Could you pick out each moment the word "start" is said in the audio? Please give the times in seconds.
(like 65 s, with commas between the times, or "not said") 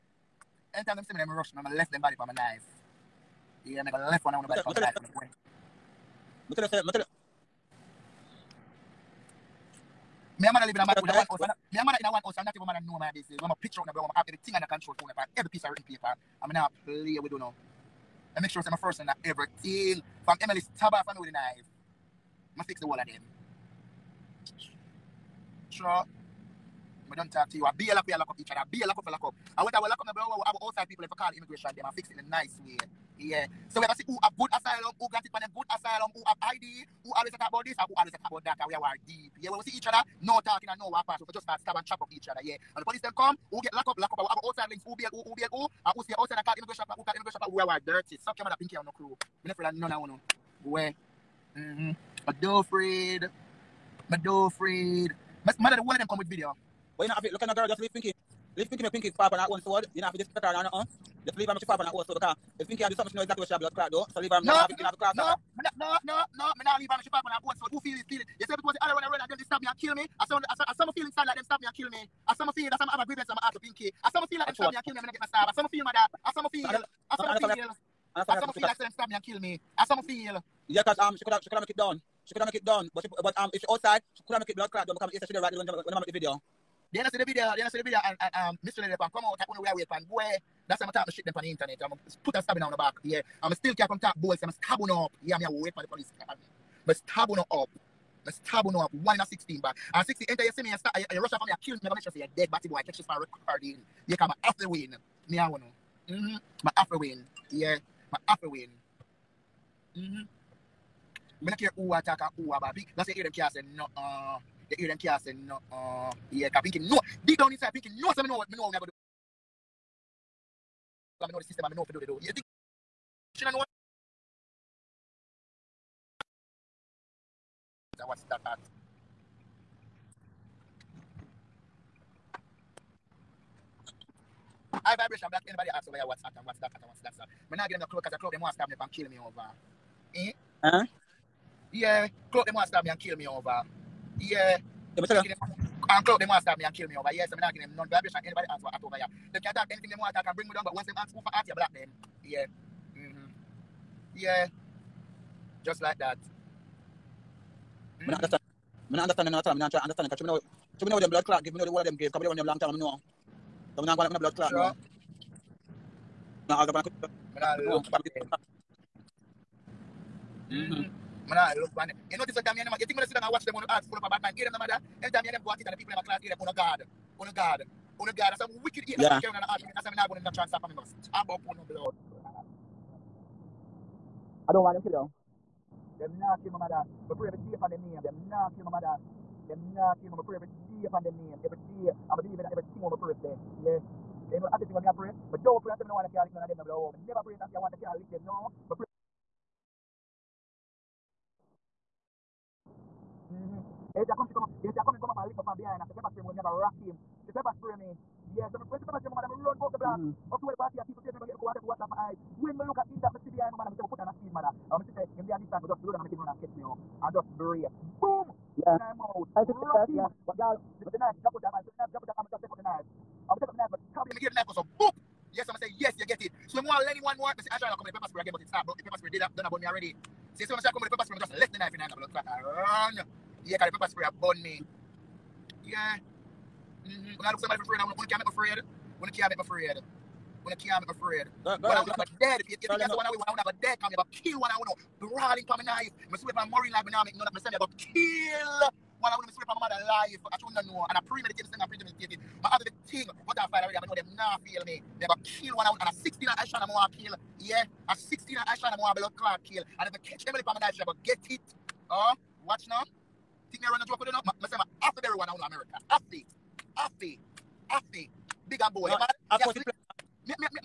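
41 s, 100 s.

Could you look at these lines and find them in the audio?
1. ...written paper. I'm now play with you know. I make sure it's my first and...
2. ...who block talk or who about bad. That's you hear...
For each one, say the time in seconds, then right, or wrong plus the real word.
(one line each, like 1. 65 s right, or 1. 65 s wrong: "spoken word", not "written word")
1. 15 s right
2. 111 s wrong: "attack", not "block".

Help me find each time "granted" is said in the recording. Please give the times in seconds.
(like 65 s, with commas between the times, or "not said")
35 s.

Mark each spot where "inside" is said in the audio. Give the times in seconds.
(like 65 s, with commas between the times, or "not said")
71 s, 117 s.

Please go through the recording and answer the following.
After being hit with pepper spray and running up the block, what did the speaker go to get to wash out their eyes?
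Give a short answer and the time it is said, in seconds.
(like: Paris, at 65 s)
water, at 211 s.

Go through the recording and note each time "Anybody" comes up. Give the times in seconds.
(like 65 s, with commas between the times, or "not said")
135 s, 148 s.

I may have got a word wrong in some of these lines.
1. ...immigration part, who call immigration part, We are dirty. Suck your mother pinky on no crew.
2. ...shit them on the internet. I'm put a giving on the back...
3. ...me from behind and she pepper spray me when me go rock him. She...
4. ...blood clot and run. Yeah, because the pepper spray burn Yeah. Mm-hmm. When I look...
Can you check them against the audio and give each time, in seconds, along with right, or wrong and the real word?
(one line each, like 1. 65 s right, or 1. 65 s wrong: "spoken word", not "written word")
1. 46 s right
2. 91 s wrong: "stabbing", not "giving"
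3. 205 s right
4. 231 s right.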